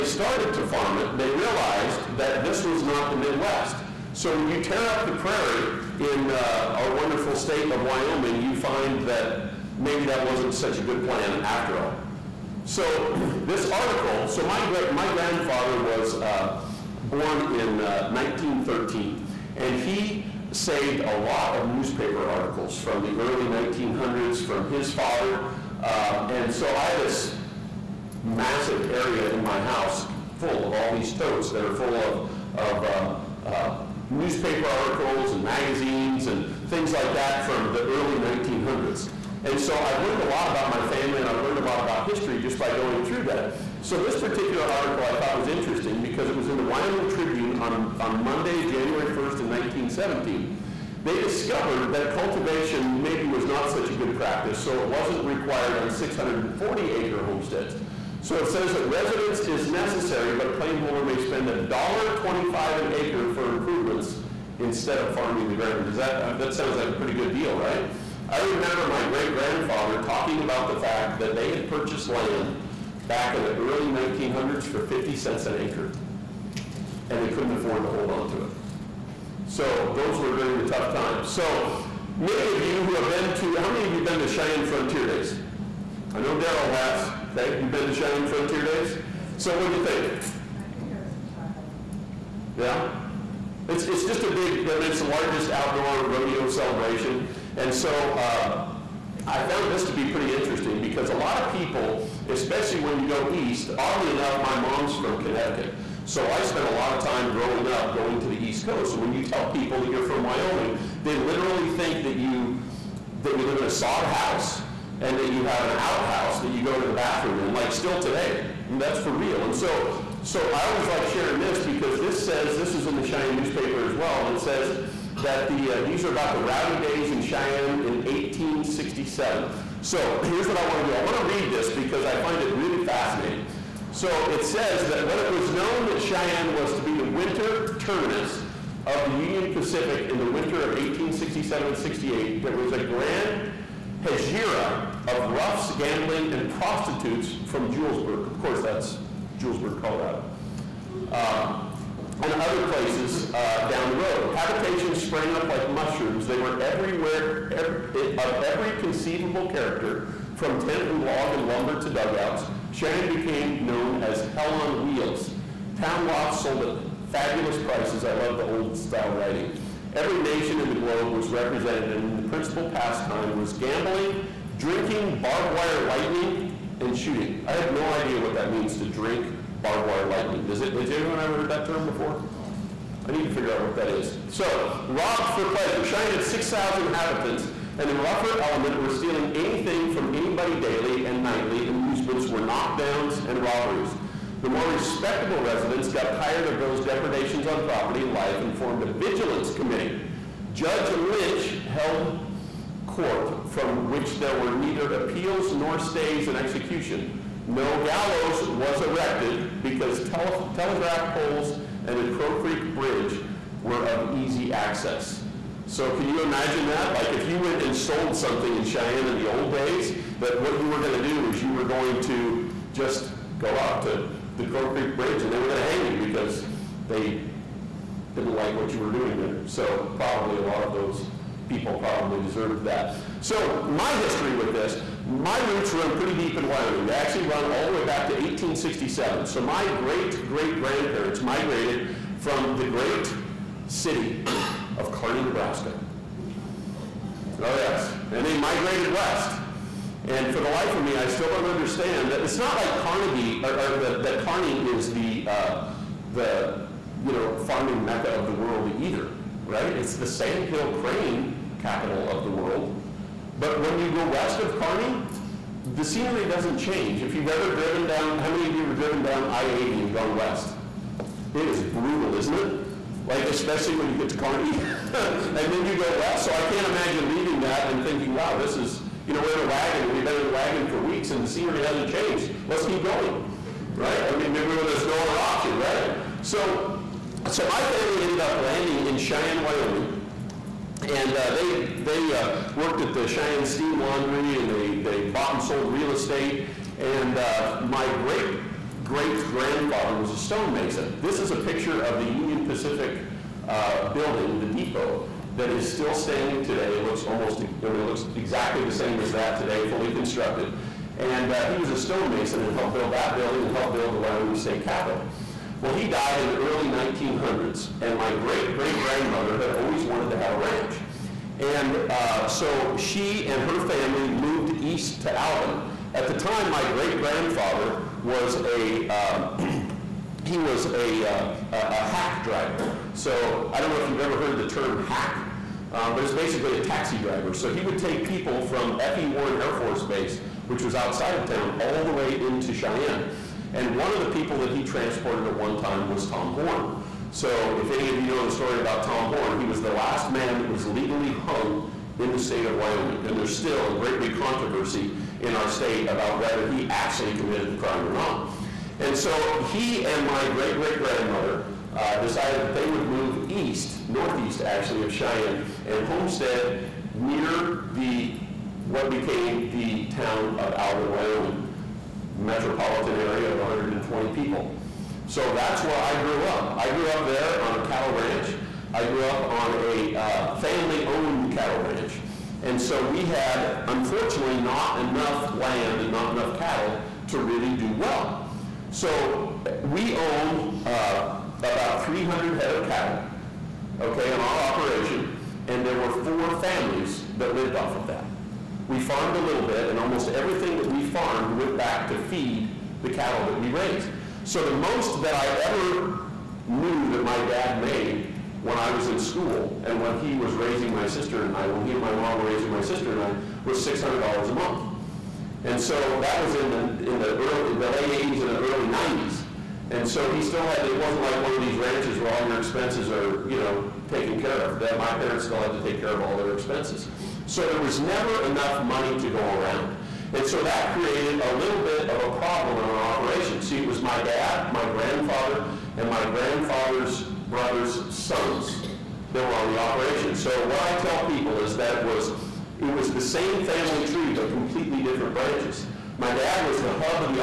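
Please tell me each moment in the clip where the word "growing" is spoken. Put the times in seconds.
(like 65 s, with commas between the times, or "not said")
107 s.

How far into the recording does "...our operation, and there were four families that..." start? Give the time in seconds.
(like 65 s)
394 s.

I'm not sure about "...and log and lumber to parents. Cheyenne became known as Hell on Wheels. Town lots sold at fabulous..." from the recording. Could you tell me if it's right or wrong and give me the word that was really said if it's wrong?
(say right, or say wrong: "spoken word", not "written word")
wrong: "dugouts", not "parents".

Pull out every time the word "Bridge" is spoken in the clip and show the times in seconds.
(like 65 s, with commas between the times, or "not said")
212 s, 224 s.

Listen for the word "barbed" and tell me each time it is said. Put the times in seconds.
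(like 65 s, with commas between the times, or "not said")
175 s, 179 s.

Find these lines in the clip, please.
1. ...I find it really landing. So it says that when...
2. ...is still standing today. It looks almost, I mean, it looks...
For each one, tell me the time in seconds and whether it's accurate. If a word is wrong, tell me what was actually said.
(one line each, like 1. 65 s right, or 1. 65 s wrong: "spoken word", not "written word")
1. 132 s wrong: "fascinating", not "landing"
2. 305 s right.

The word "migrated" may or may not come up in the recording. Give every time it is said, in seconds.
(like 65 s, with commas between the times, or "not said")
241 s, 248 s.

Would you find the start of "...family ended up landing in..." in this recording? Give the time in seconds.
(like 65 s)
287 s.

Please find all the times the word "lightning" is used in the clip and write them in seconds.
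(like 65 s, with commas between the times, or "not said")
175 s, 180 s.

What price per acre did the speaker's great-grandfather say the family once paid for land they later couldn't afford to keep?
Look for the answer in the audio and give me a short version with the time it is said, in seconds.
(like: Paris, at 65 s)
50 cents, at 74 s.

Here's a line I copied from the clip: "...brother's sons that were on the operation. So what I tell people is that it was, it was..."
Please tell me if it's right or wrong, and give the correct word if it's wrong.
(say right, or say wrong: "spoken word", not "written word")
right.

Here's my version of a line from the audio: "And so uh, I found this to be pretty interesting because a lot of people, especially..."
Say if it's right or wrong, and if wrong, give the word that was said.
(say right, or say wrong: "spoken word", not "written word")
right.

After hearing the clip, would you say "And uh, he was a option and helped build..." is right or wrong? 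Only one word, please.
wrong.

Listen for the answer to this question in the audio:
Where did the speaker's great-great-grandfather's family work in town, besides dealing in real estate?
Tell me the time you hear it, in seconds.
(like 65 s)
293 s.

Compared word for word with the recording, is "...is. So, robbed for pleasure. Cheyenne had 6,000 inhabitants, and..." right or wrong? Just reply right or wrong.
right.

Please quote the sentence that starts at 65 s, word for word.
Does that, uh, that sounds like a pretty good deal, right?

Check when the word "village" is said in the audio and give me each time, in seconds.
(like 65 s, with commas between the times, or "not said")
not said.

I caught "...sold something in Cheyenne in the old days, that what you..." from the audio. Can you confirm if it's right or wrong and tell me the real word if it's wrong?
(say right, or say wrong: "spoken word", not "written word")
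right.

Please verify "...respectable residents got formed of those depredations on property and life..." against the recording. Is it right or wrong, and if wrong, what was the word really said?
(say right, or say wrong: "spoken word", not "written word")
wrong: "tired", not "formed".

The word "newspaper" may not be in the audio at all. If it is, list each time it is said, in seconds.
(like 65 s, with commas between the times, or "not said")
21 s, 34 s, 123 s.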